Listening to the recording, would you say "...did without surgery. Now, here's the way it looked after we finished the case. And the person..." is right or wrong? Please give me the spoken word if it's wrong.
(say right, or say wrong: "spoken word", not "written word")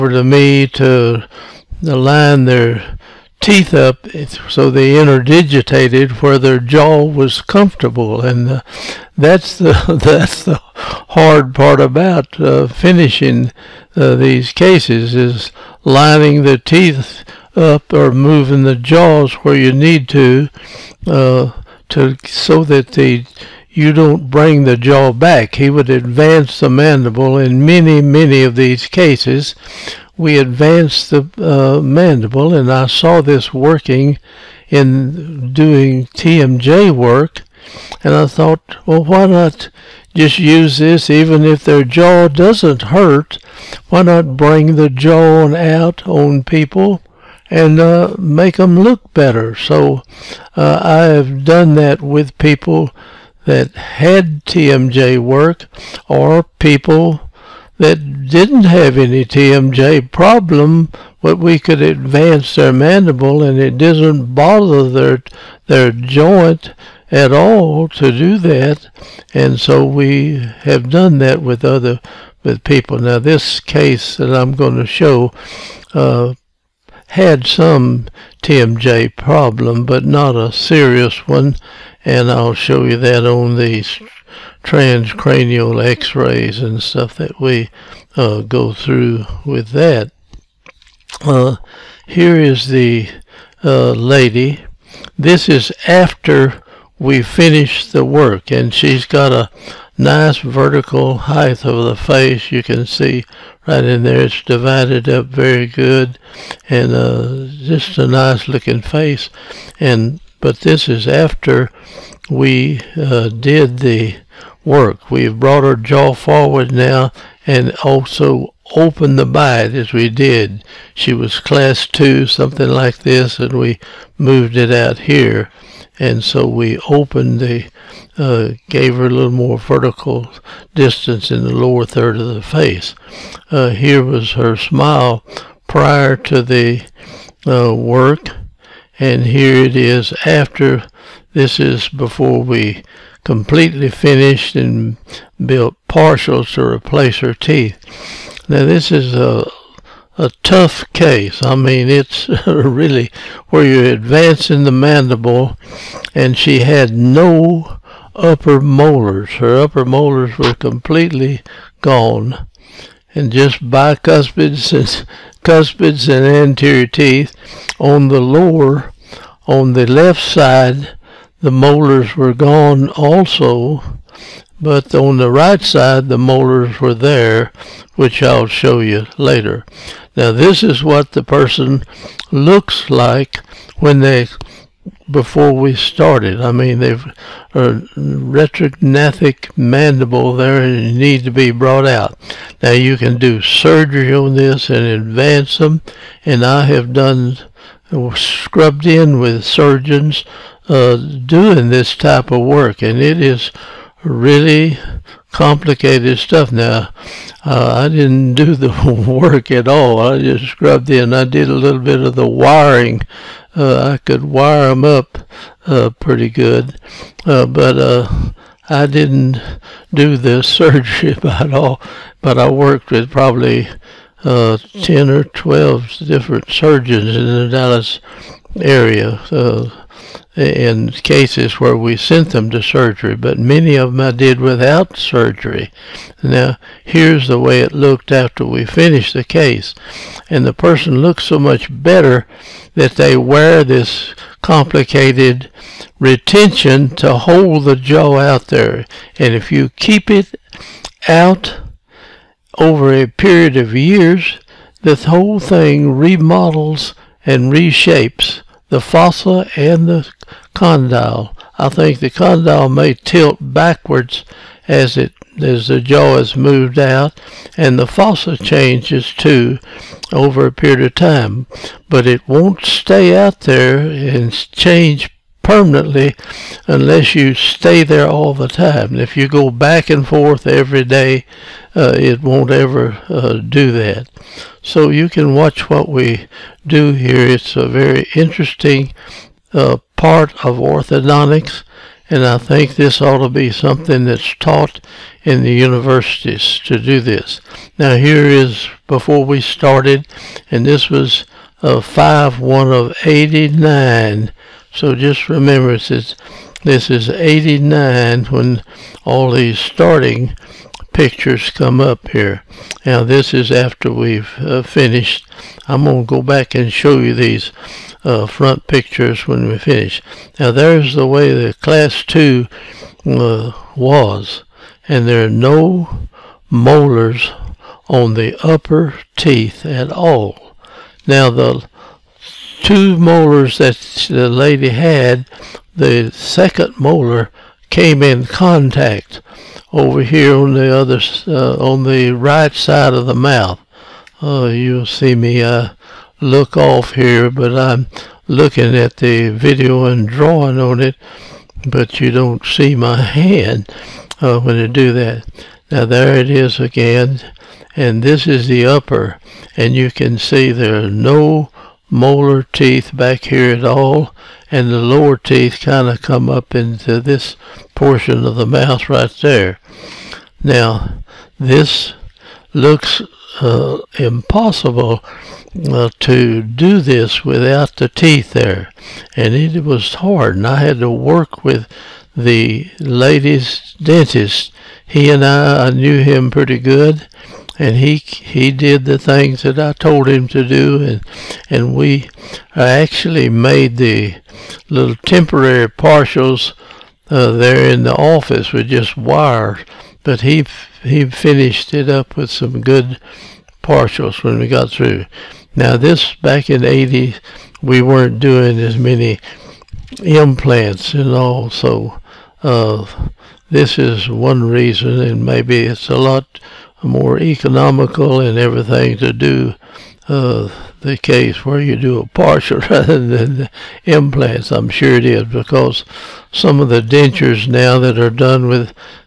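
right.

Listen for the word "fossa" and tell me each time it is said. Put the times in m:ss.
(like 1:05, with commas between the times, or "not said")
4:18, 4:27.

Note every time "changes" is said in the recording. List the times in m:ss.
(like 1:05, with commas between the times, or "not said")
4:28, 4:34.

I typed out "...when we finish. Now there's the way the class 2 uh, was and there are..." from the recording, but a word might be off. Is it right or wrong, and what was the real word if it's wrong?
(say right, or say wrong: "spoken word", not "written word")
right.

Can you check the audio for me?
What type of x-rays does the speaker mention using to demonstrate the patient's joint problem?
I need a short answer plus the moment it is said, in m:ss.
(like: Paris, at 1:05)
Transcranial x-rays, at 1:24.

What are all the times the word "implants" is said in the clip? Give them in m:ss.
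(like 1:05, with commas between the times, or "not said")
6:50, 7:03.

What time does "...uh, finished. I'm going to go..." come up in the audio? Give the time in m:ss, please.
5:14.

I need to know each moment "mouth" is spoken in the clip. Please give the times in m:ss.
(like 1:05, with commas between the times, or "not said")
5:43, 6:08.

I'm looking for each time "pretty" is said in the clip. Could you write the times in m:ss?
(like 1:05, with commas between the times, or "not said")
3:35, 6:26.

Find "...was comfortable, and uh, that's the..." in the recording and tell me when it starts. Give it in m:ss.
0:07.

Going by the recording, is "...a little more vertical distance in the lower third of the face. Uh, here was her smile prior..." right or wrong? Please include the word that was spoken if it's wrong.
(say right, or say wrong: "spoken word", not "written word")
right.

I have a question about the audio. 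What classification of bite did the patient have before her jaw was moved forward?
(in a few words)
Class 2.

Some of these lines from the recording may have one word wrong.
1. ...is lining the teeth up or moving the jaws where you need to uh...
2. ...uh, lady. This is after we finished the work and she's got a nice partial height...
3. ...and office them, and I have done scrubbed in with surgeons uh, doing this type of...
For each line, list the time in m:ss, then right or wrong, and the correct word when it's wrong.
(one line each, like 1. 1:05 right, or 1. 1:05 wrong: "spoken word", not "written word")
1. 0:15 right
2. 1:33 wrong: "vertical", not "partial"
3. 3:14 wrong: "advance", not "office".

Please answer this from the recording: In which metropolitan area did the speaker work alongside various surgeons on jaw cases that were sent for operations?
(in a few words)
Dallas.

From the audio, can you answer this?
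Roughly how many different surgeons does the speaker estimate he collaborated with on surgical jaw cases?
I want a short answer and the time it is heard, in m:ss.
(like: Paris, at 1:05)
10 or 12, at 3:44.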